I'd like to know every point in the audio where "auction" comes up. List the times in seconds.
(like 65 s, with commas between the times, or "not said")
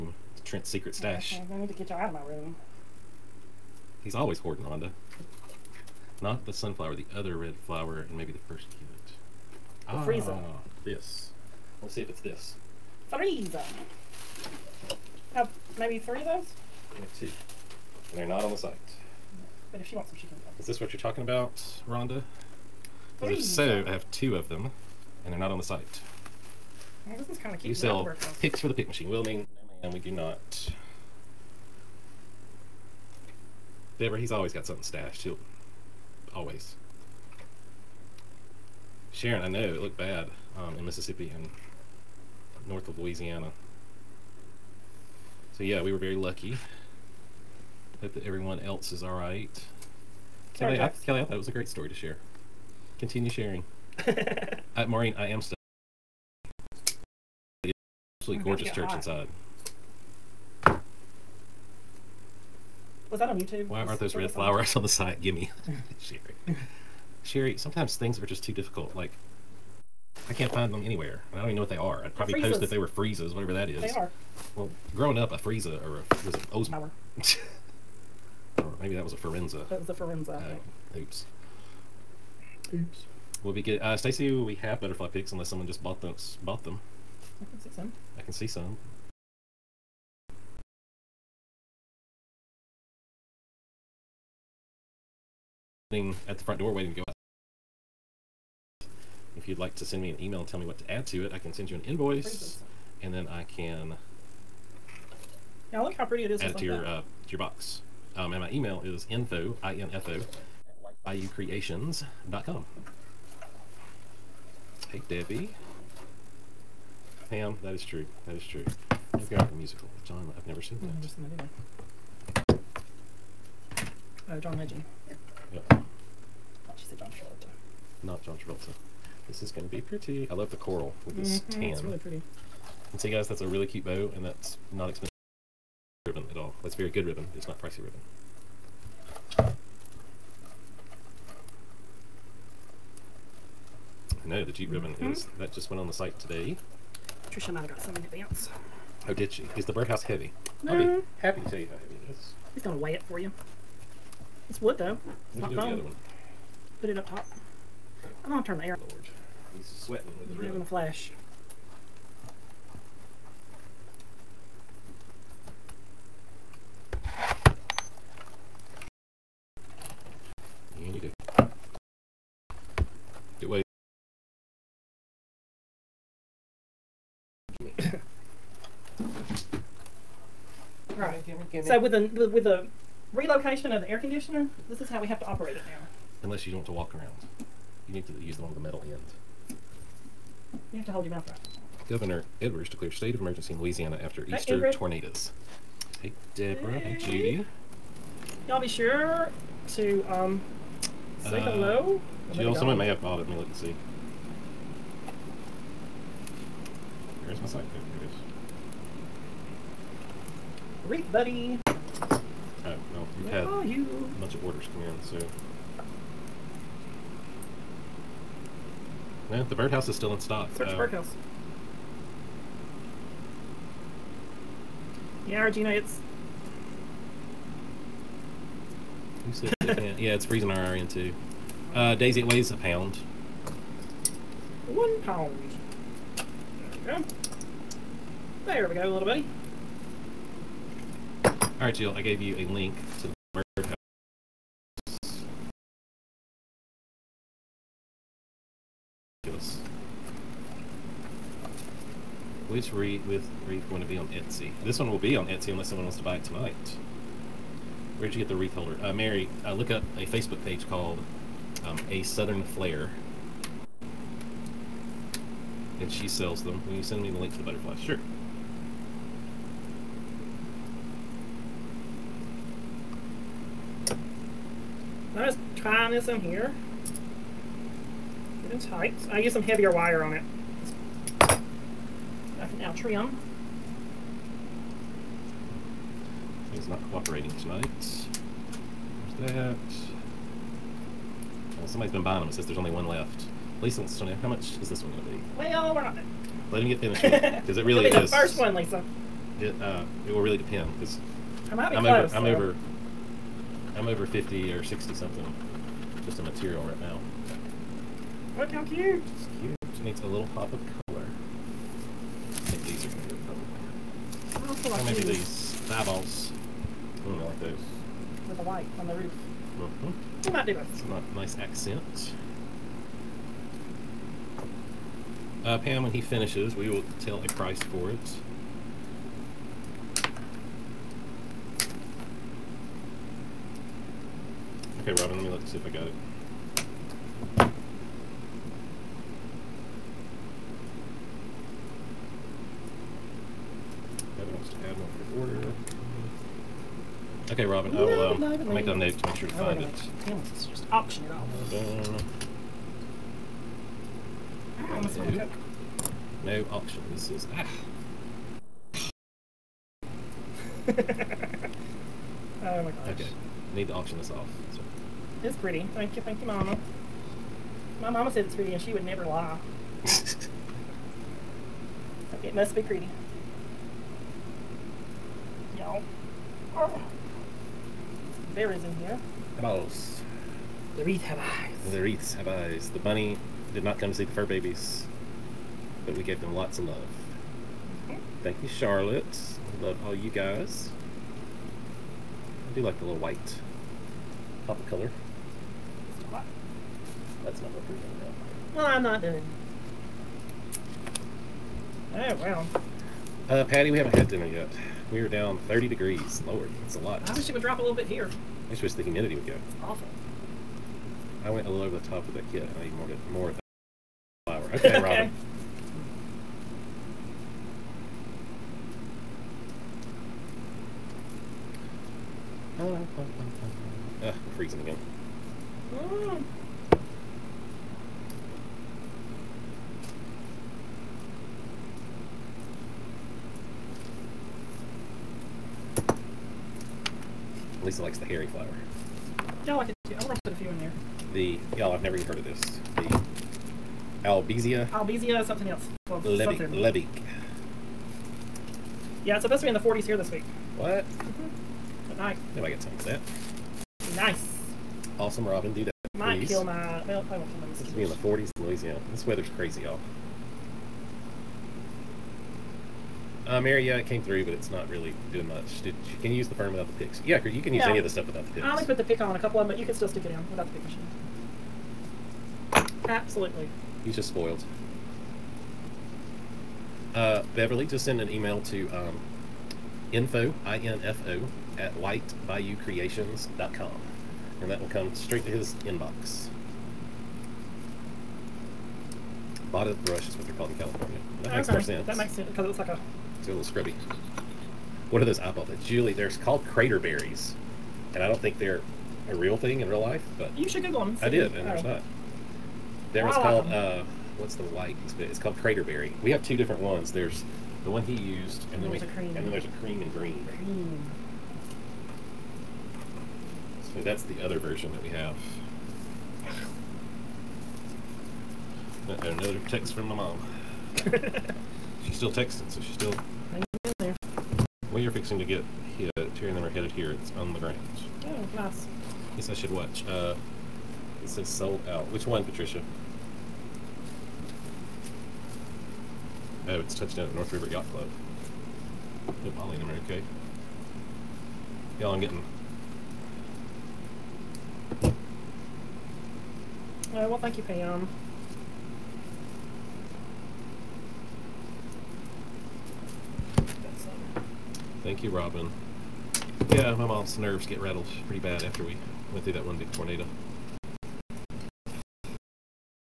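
350 s, 356 s, 363 s.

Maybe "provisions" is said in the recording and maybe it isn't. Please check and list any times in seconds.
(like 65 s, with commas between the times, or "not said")
not said.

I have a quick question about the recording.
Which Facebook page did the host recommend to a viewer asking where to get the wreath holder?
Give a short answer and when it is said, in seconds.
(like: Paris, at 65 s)
A Southern Flair, at 261 s.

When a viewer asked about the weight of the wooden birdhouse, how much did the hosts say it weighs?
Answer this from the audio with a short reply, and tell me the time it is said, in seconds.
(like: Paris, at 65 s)
1 pound, at 234 s.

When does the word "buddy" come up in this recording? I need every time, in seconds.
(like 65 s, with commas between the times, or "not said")
211 s, 239 s.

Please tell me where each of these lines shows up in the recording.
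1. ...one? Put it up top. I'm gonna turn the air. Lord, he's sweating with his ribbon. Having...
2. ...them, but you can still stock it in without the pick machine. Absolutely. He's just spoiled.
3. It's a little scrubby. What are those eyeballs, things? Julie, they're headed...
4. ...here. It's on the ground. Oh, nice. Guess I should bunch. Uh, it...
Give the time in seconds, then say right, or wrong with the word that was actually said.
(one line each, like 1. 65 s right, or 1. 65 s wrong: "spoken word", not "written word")
1. 155 s right
2. 469 s wrong: "stick", not "stock"
3. 493 s wrong: "called", not "headed"
4. 526 s wrong: "watch", not "bunch".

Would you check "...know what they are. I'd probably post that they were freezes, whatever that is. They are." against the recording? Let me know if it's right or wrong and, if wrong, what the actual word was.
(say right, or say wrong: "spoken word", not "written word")
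right.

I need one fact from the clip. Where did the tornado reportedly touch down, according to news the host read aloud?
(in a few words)
North River Yacht Club.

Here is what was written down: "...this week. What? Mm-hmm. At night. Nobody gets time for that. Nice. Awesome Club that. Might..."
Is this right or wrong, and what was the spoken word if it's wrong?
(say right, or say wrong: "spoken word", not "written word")
wrong: "Robin", not "Club".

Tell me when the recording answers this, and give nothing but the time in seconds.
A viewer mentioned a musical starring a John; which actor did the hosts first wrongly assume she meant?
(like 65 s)
124 s.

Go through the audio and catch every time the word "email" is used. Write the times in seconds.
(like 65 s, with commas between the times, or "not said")
100 s, 108 s, 478 s.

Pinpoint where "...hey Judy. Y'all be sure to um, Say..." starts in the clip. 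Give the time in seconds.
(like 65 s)
196 s.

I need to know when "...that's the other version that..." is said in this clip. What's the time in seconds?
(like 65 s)
513 s.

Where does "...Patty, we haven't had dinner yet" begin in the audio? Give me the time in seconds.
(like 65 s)
403 s.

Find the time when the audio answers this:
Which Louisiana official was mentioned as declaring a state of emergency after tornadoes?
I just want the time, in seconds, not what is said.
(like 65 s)
191 s.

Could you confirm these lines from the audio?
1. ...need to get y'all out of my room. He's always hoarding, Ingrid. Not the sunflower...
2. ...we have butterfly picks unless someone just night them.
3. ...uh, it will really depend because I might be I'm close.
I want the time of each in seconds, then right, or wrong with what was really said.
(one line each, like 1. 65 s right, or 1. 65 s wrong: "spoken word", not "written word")
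1. 1 s wrong: "Rhonda", not "Ingrid"
2. 84 s wrong: "bought", not "night"
3. 299 s right.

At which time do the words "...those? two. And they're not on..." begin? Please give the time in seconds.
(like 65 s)
16 s.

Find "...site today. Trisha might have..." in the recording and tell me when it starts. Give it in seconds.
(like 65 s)
145 s.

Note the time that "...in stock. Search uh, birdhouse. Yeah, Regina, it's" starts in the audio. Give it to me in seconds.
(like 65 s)
220 s.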